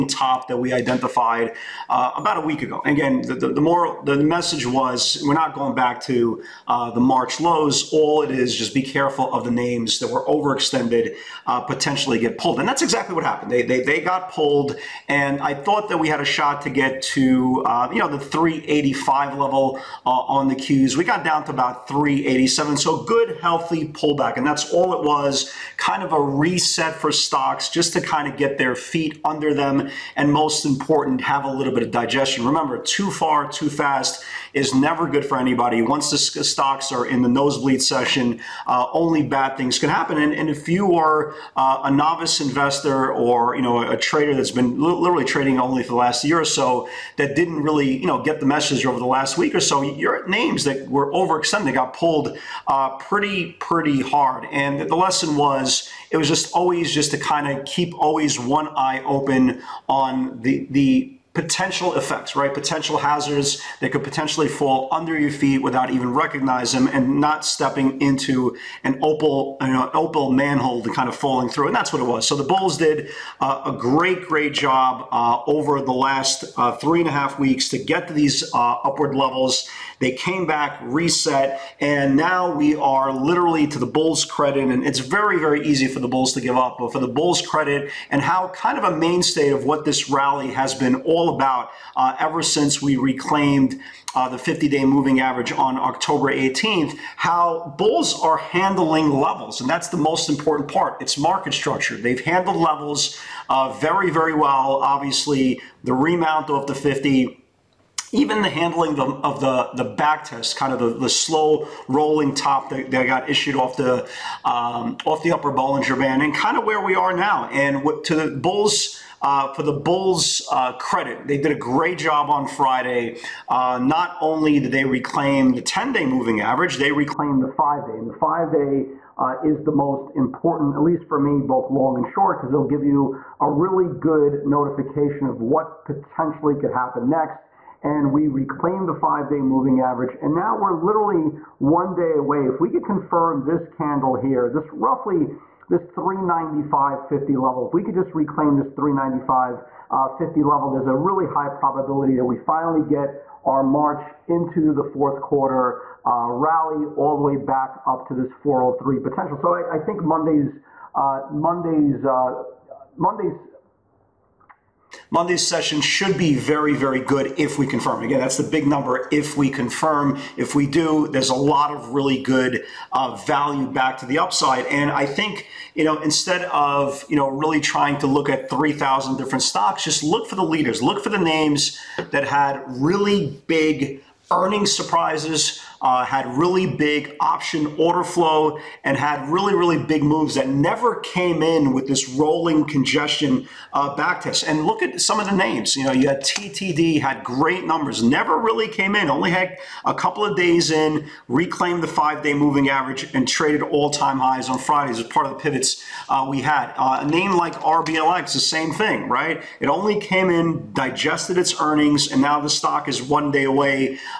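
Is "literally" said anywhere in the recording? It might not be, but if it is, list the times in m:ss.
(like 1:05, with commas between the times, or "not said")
0:44, 1:23, 2:20.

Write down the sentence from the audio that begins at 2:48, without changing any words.
Again, that's the big number if we confirm.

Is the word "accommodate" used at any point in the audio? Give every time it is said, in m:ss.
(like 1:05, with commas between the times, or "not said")
not said.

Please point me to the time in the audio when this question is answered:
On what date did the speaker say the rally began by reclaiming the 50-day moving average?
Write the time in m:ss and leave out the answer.
1:35.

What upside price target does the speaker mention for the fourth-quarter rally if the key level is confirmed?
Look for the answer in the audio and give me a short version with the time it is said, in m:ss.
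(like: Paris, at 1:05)
403, at 2:38.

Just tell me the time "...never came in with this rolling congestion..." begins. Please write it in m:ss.
3:10.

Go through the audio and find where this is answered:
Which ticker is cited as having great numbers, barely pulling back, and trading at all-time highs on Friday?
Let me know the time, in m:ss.
3:16.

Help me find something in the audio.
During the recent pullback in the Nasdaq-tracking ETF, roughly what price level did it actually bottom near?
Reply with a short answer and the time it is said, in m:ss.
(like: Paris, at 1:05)
387, at 0:21.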